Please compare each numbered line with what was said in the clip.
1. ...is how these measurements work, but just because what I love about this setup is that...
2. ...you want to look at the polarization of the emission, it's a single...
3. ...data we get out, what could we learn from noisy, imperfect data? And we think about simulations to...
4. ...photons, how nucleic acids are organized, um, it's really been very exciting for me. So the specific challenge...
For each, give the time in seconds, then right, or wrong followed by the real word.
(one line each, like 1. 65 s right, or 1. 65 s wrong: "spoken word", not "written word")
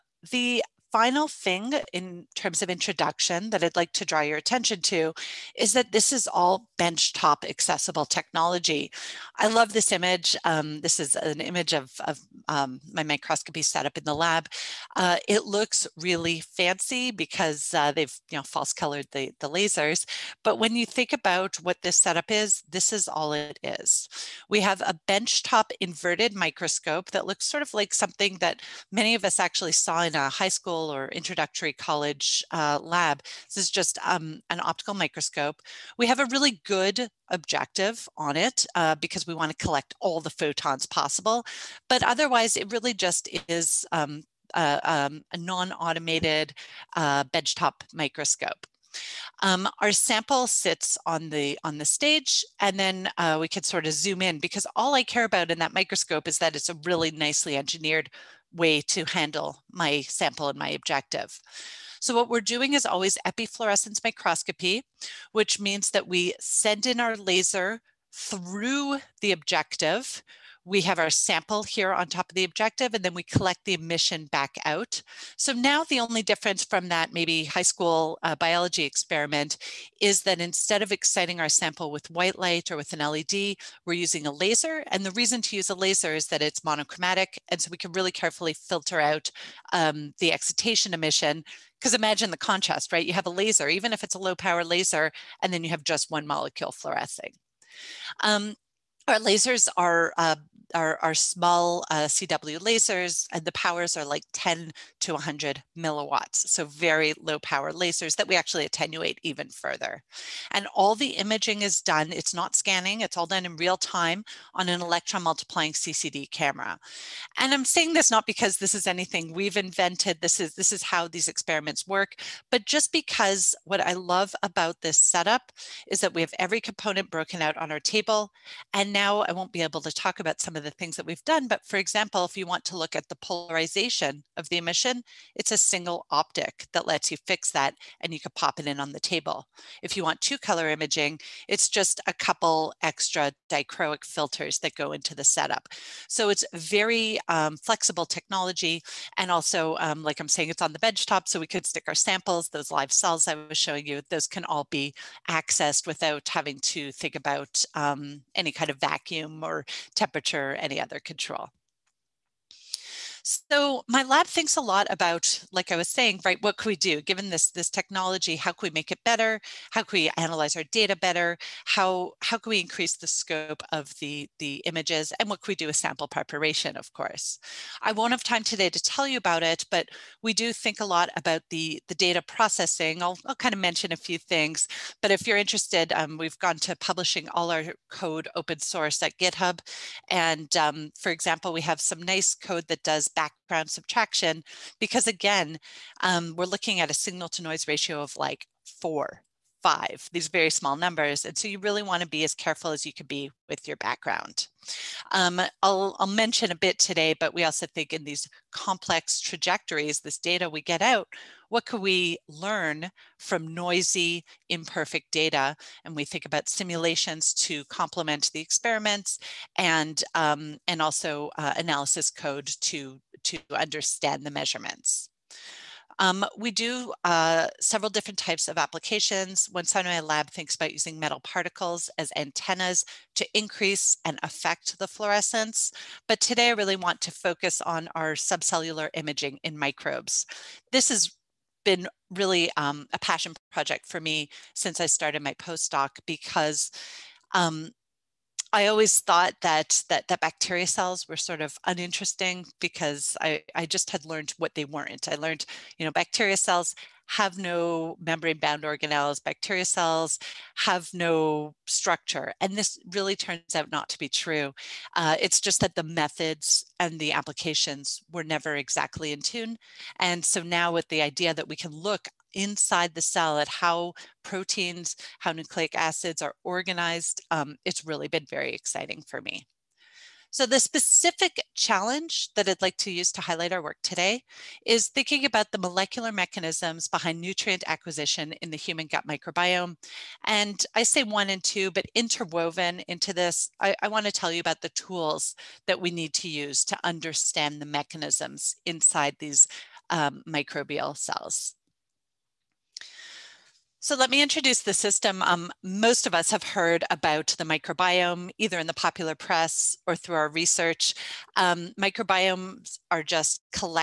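1. 120 s wrong: "experiments", not "measurements"
2. 132 s right
3. 210 s right
4. 274 s wrong: "proteins", not "photons".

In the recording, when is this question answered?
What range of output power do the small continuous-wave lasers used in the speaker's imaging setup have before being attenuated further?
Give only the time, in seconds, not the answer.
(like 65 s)
104 s.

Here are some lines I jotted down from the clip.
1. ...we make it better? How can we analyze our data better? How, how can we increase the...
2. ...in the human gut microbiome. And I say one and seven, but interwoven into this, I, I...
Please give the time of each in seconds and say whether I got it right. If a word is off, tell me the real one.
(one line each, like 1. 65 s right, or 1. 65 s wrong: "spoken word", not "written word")
1. 168 s right
2. 288 s wrong: "two", not "seven".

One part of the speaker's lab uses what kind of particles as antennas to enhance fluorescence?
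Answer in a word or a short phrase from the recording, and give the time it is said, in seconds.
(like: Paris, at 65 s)
metal particles, at 230 s.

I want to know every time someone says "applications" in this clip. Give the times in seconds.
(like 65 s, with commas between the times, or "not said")
228 s, 267 s.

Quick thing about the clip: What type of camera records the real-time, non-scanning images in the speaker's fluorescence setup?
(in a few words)
electron multiplying CCD camera.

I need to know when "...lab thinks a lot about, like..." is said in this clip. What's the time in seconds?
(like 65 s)
164 s.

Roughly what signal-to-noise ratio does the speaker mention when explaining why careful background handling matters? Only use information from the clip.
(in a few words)
four, five.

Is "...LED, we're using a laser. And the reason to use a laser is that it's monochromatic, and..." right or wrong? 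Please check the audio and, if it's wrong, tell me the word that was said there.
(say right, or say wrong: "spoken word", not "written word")
right.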